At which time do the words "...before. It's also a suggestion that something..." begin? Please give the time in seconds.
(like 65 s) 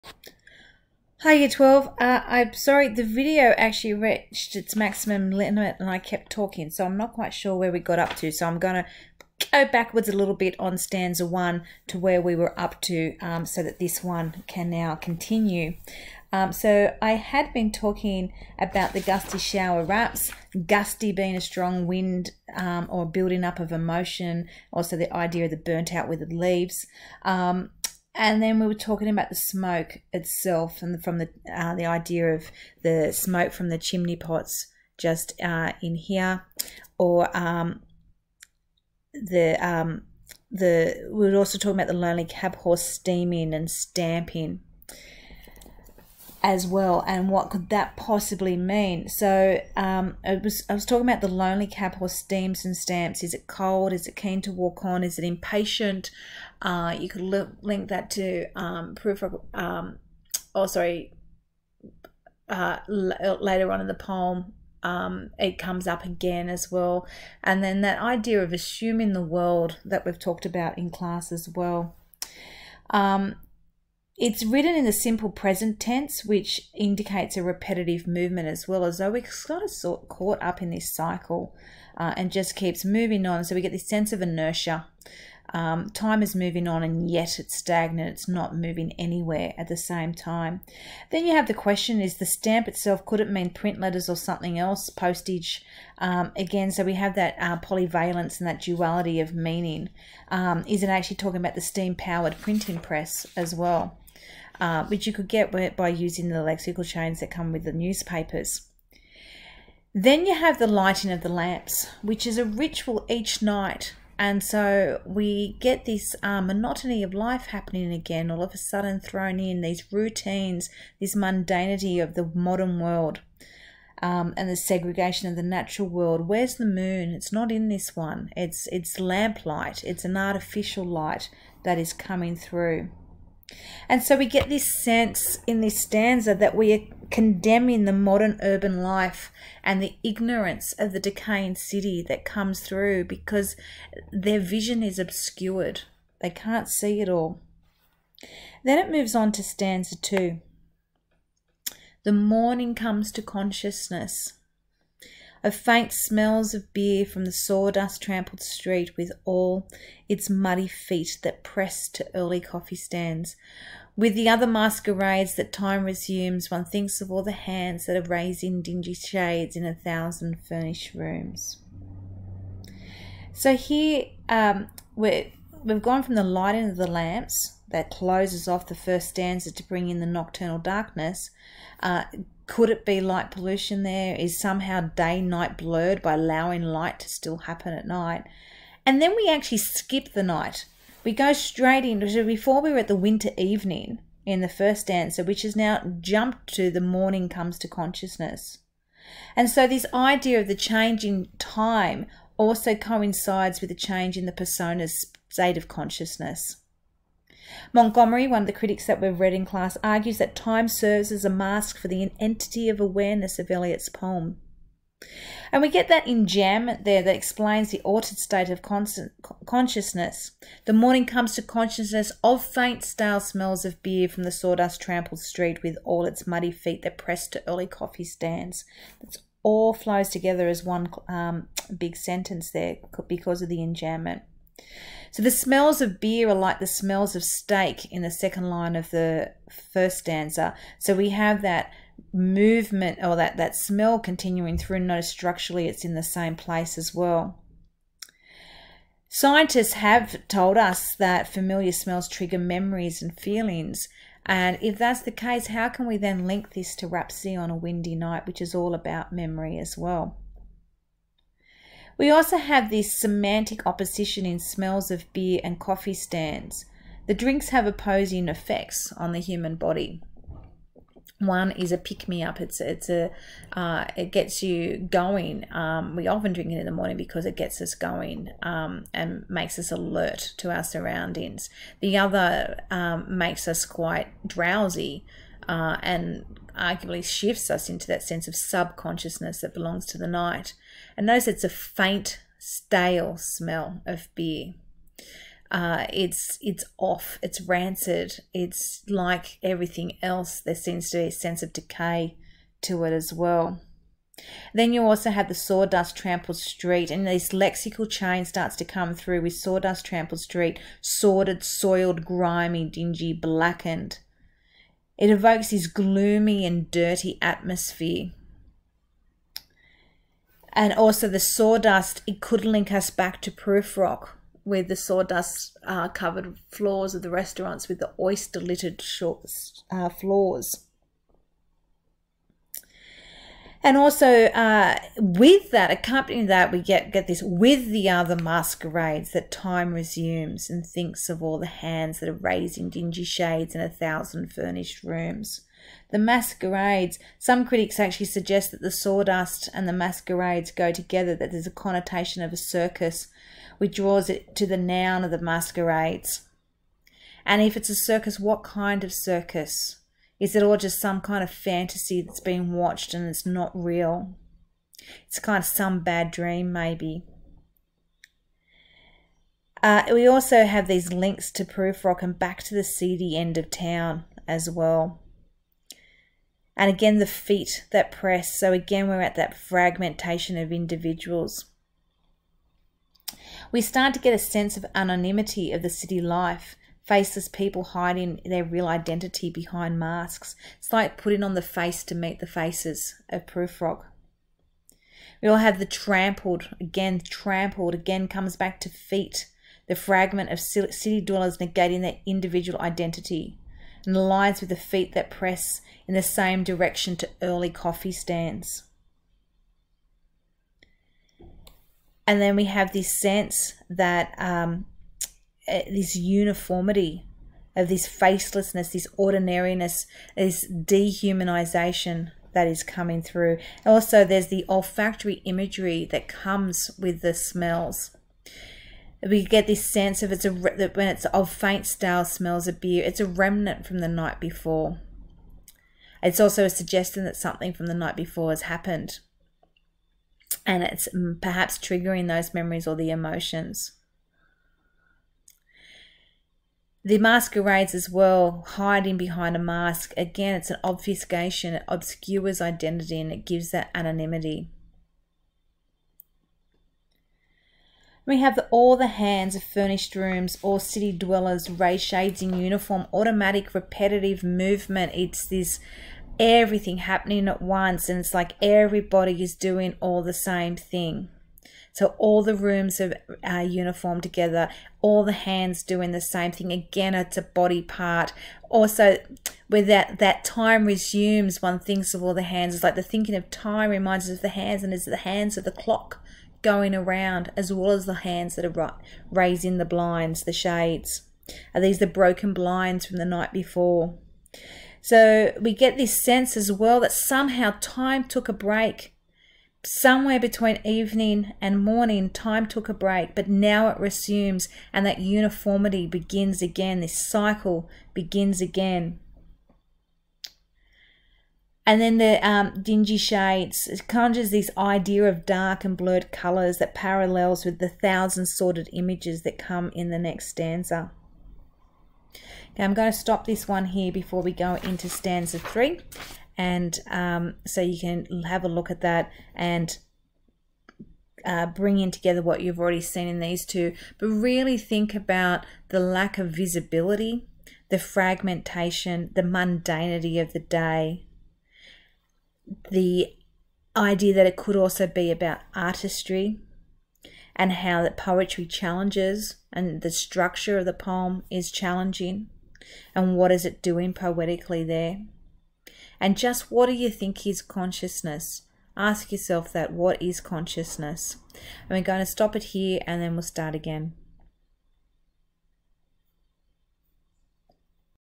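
434 s.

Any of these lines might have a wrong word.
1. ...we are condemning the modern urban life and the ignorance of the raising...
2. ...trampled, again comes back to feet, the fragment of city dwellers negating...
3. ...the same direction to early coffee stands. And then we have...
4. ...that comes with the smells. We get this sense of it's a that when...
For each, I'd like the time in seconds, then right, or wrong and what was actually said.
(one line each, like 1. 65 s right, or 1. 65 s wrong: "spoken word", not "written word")
1. 136 s wrong: "decaying", not "raising"
2. 396 s right
3. 405 s right
4. 425 s right.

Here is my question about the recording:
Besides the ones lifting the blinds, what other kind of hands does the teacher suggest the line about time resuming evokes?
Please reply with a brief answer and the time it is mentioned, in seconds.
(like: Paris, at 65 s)
the hands of the clock, at 484 s.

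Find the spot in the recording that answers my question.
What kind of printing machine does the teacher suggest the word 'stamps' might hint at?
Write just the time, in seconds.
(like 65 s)
101 s.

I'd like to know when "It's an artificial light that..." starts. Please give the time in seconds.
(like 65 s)
129 s.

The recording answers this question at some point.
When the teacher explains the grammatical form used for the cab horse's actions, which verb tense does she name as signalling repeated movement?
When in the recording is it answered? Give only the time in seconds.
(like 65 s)
74 s.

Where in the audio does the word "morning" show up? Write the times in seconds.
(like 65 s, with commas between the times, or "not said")
152 s, 196 s, 220 s, 276 s, 501 s.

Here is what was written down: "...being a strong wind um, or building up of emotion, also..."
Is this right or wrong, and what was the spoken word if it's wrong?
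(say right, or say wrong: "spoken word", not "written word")
right.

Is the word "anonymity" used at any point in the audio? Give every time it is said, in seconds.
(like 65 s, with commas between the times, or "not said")
384 s, 453 s.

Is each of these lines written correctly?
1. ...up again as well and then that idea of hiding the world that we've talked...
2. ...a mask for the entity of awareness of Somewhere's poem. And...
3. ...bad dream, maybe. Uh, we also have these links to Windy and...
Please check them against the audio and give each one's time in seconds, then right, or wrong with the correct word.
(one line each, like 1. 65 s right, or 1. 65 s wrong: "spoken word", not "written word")
1. 65 s wrong: "assuming", not "hiding"
2. 211 s wrong: "Eliot", not "Somewhere"
3. 365 s wrong: "Prufrock", not "Windy".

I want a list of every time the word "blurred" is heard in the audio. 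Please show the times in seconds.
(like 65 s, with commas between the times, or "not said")
185 s, 515 s.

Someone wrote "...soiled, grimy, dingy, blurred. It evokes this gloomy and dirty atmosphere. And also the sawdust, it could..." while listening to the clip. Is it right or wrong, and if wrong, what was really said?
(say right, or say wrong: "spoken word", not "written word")
wrong: "blackened", not "blurred".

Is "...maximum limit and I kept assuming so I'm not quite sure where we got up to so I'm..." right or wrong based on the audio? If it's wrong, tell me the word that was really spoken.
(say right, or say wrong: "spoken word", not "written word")
wrong: "talking", not "assuming".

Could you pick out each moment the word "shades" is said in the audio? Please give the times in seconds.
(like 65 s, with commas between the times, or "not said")
168 s, 343 s, 461 s, 490 s, 512 s.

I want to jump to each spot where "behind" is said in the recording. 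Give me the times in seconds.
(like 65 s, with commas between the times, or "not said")
389 s, 448 s.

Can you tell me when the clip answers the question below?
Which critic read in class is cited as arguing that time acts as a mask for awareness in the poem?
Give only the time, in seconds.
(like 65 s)
207 s.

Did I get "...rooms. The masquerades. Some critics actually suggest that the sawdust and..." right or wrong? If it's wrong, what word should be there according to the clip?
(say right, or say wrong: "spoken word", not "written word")
right.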